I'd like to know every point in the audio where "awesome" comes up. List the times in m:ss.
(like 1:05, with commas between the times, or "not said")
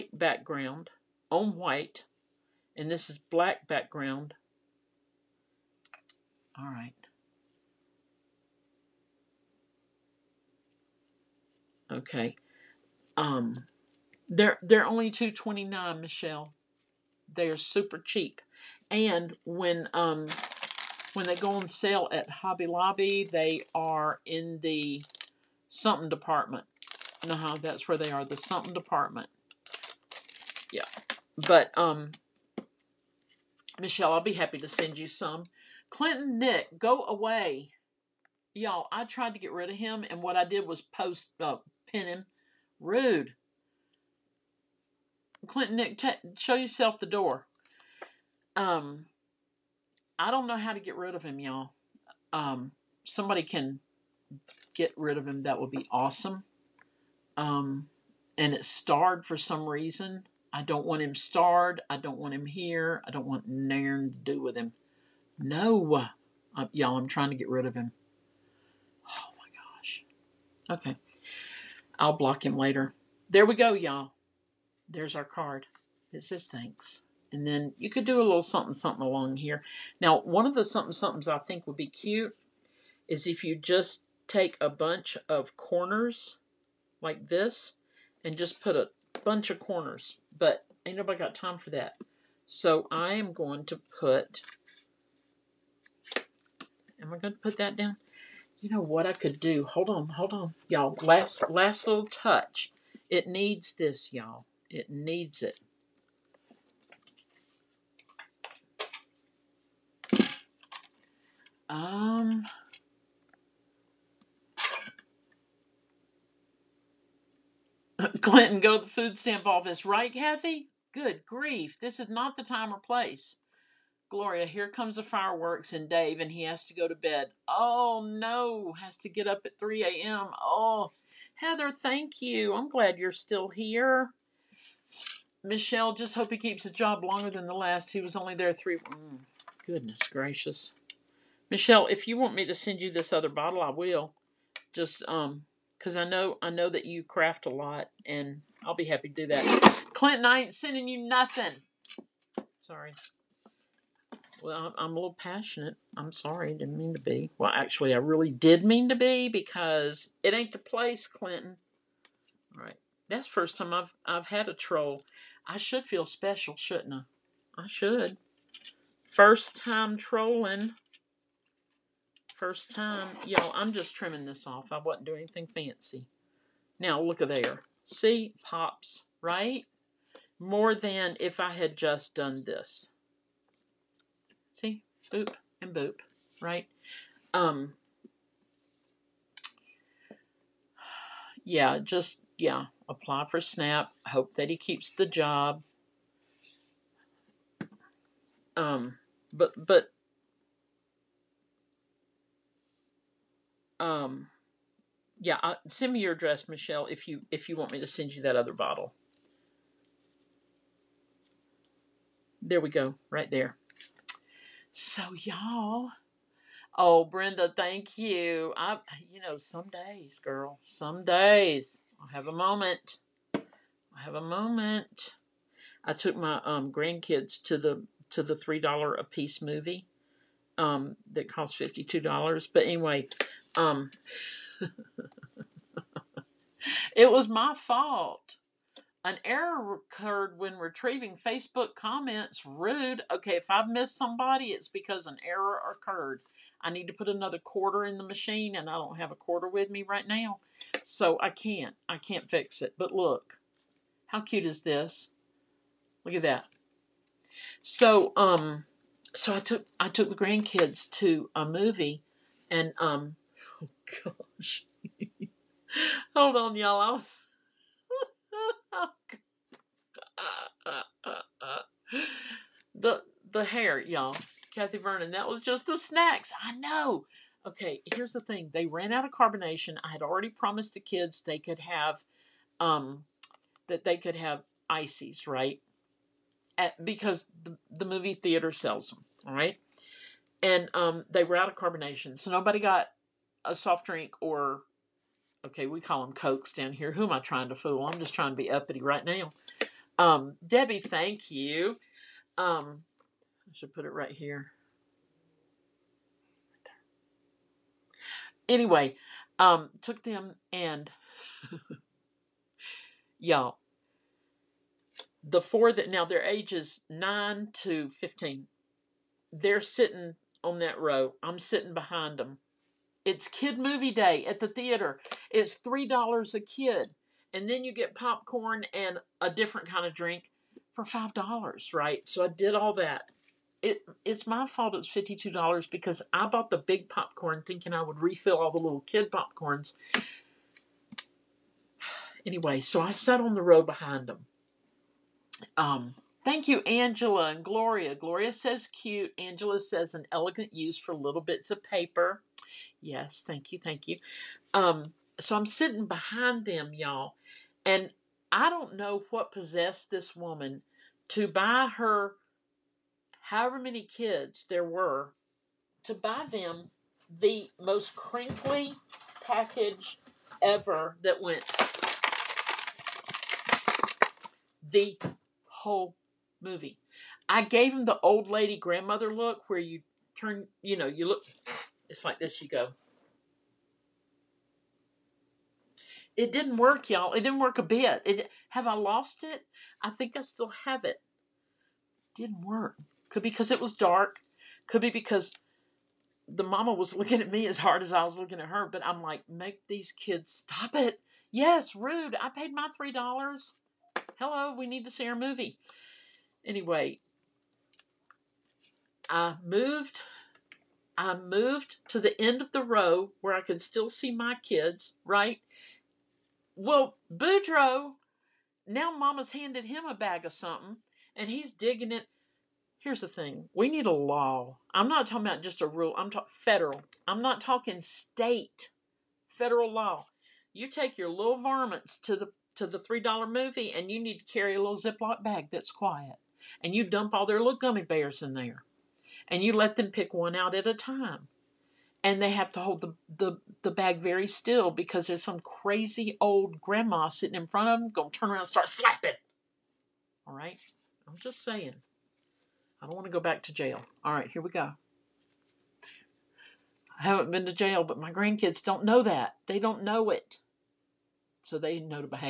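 0:55.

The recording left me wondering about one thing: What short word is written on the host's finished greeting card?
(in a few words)
Thanks.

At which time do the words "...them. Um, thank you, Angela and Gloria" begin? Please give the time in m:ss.
5:44.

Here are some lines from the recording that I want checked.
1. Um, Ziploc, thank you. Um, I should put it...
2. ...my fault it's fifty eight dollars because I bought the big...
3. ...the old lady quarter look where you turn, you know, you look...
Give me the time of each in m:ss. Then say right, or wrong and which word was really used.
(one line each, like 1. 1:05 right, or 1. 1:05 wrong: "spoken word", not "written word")
1. 4:59 wrong: "Debbie", not "Ziploc"
2. 5:34 wrong: "two", not "eight"
3. 6:17 wrong: "grandmother", not "quarter".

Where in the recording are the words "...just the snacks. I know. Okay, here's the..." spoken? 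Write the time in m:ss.
4:35.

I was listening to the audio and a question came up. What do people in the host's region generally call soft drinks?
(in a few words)
cokes.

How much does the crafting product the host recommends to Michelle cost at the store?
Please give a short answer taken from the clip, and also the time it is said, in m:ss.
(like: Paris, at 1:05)
2.29, at 0:15.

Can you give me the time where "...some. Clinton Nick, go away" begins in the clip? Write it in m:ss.
0:35.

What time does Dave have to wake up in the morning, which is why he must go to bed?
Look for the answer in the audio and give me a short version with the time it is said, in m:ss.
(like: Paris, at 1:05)
3 a.m., at 2:09.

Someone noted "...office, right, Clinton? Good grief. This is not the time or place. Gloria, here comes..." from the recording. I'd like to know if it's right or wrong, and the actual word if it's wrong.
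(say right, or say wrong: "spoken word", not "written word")
wrong: "Kathy", not "Clinton".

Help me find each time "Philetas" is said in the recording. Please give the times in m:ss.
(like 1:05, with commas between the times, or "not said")
not said.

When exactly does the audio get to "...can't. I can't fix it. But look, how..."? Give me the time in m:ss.
4:11.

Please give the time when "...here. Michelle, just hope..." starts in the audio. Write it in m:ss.
2:13.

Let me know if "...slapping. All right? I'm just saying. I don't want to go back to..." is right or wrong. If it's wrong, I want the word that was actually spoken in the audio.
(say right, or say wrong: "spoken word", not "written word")
right.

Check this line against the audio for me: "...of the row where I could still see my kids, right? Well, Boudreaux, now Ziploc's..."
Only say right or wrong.
wrong.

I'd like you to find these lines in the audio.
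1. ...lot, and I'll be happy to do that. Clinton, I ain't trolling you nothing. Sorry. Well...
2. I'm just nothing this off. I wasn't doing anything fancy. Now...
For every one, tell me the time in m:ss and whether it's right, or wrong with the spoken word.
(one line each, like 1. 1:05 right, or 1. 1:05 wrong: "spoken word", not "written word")
1. 2:27 wrong: "sending", not "trolling"
2. 2:53 wrong: "trimming", not "nothing".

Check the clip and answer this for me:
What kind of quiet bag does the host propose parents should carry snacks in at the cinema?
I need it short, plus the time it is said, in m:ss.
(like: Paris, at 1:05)
Ziploc bag, at 7:14.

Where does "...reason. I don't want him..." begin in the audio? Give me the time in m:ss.
0:59.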